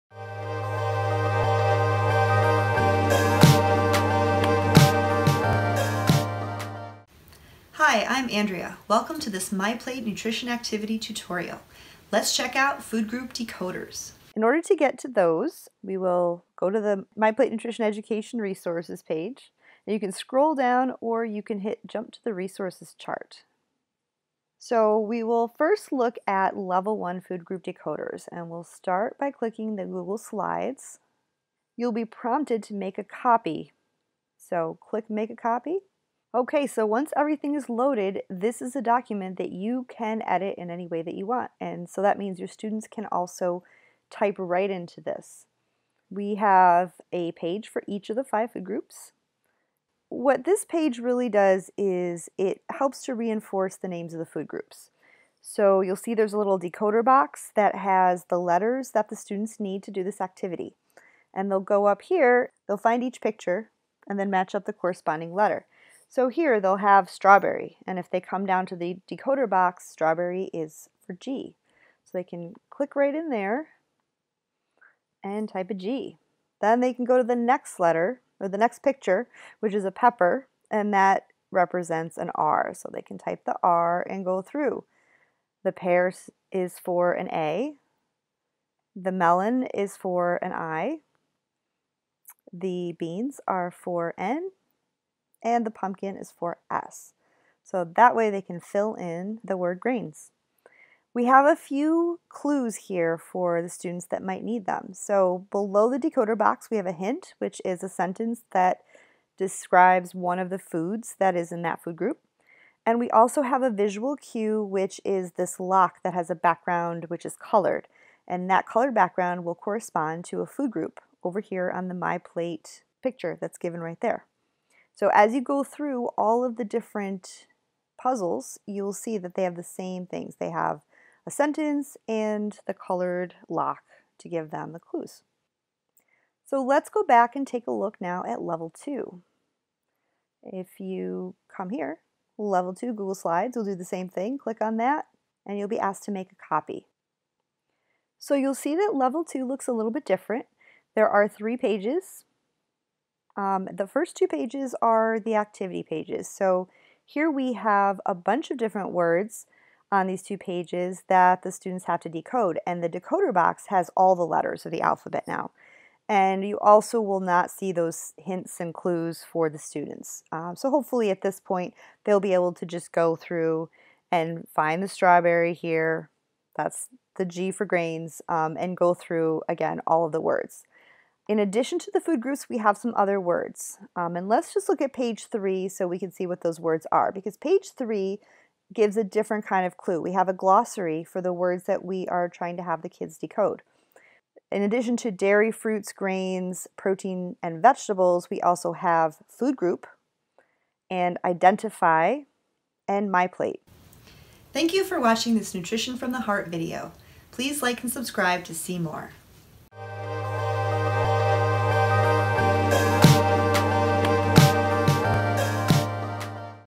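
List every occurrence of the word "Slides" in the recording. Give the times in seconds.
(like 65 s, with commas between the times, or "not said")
30 s, 143 s.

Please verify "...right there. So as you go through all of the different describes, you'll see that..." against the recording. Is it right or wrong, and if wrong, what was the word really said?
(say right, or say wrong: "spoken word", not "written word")
wrong: "puzzles", not "describes".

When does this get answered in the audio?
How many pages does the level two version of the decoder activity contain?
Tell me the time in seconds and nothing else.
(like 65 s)
151 s.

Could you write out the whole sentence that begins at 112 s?
And we also have a visual cue, which is this lock that has a background which is colored.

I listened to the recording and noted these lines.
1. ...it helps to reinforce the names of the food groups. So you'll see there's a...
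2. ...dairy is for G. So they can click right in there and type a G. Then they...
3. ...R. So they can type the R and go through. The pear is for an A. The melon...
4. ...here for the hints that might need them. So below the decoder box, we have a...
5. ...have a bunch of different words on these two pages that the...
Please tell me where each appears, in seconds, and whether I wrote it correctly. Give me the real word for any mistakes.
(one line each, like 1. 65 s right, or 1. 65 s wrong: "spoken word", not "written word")
1. 52 s right
2. 69 s wrong: "strawberry", not "dairy"
3. 82 s right
4. 102 s wrong: "students", not "hints"
5. 157 s right.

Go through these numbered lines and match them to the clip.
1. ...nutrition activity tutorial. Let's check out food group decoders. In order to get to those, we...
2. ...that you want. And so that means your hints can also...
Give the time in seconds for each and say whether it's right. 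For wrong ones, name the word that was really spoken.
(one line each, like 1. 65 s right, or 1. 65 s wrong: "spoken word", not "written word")
1. 10 s right
2. 41 s wrong: "students", not "hints".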